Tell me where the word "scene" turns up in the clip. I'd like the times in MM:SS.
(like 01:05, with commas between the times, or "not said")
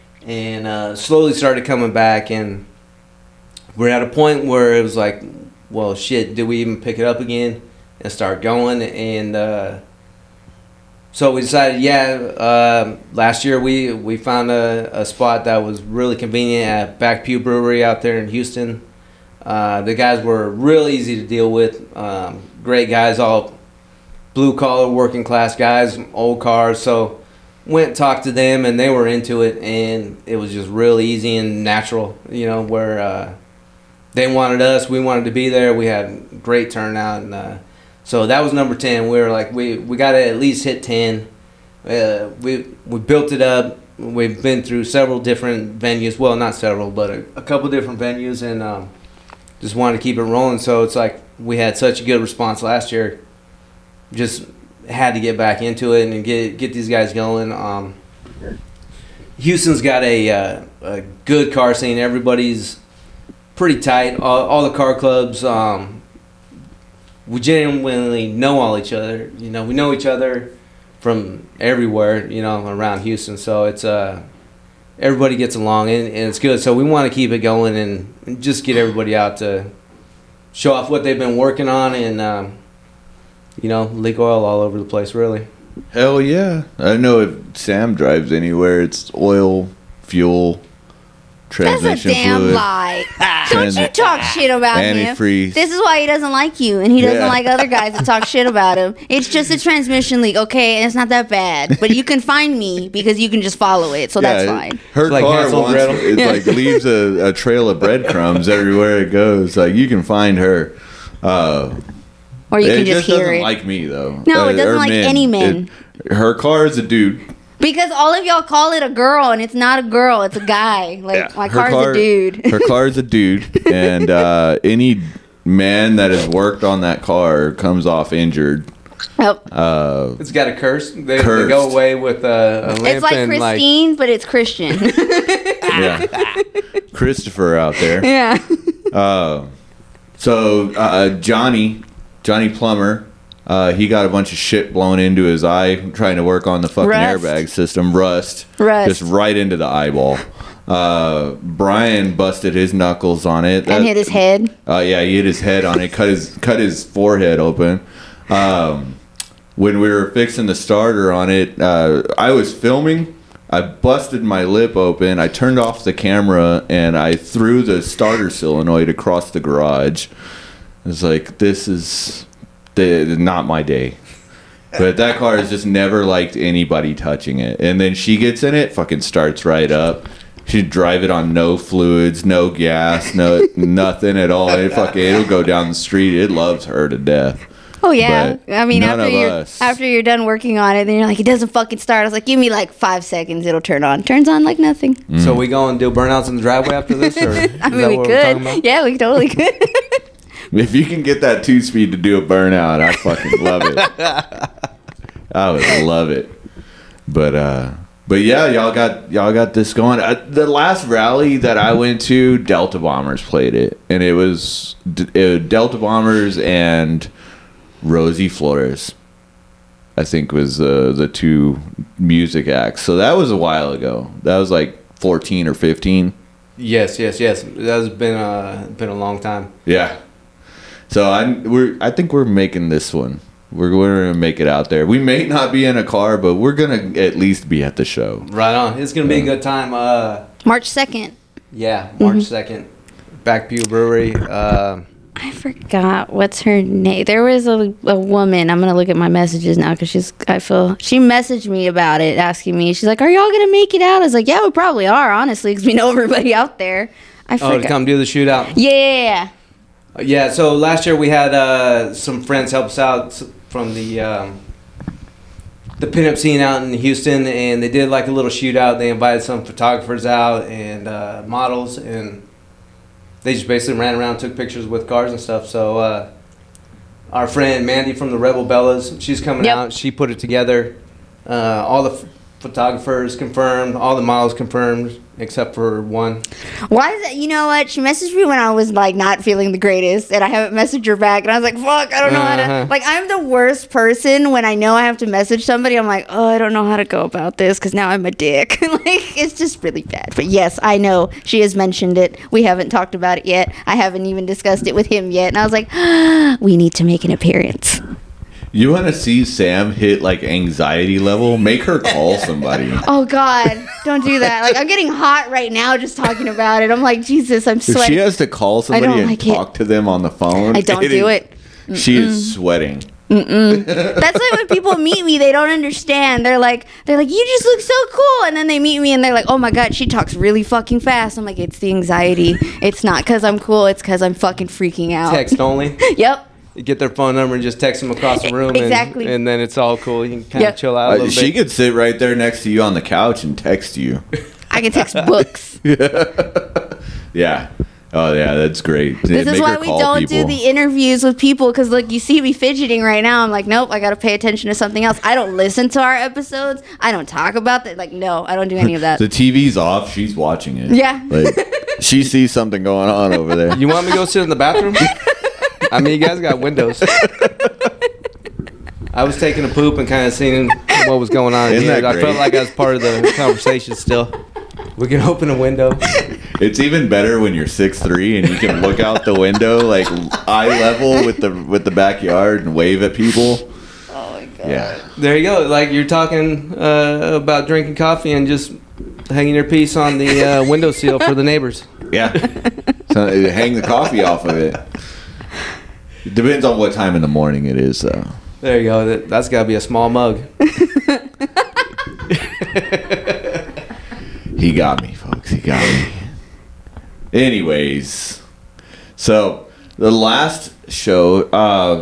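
01:01, 04:26.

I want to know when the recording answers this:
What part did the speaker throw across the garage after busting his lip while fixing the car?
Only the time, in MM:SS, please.
02:47.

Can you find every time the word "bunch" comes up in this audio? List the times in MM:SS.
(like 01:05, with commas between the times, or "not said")
02:24.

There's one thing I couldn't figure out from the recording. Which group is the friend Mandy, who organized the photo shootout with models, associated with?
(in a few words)
Rebel Bellas.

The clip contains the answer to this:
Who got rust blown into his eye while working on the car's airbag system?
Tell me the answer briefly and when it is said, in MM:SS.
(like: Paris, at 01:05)
Johnny Plummer, at 02:22.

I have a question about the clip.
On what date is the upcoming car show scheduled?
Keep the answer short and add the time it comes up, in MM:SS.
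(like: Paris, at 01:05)
March 2nd, at 04:00.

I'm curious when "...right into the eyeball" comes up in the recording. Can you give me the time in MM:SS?
02:29.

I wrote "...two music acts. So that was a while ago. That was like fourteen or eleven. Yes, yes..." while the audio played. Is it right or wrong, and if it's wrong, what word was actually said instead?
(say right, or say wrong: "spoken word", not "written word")
wrong: "fifteen", not "eleven".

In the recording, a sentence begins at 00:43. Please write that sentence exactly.
We've been through several different venues.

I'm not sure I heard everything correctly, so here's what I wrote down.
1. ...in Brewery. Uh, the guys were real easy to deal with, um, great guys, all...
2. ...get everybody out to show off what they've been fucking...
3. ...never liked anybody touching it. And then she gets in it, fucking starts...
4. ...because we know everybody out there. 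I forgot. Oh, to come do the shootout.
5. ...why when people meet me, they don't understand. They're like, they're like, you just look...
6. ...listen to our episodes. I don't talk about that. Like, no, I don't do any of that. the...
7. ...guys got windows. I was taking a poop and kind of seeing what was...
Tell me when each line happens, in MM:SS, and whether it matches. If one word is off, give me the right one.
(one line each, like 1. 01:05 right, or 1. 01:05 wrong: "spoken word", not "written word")
1. 00:18 wrong: "Houston", not "Brewery"
2. 01:18 wrong: "working", not "fucking"
3. 02:55 right
4. 04:15 right
5. 05:24 right
6. 05:55 right
7. 06:06 right.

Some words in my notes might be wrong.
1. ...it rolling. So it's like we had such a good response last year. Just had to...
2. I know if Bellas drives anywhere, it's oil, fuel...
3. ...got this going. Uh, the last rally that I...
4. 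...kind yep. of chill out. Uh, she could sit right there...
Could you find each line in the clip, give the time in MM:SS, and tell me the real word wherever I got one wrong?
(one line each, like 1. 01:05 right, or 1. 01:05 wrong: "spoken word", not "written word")
1. 00:50 right
2. 01:26 wrong: "Sam", not "Bellas"
3. 03:29 right
4. 05:40 right.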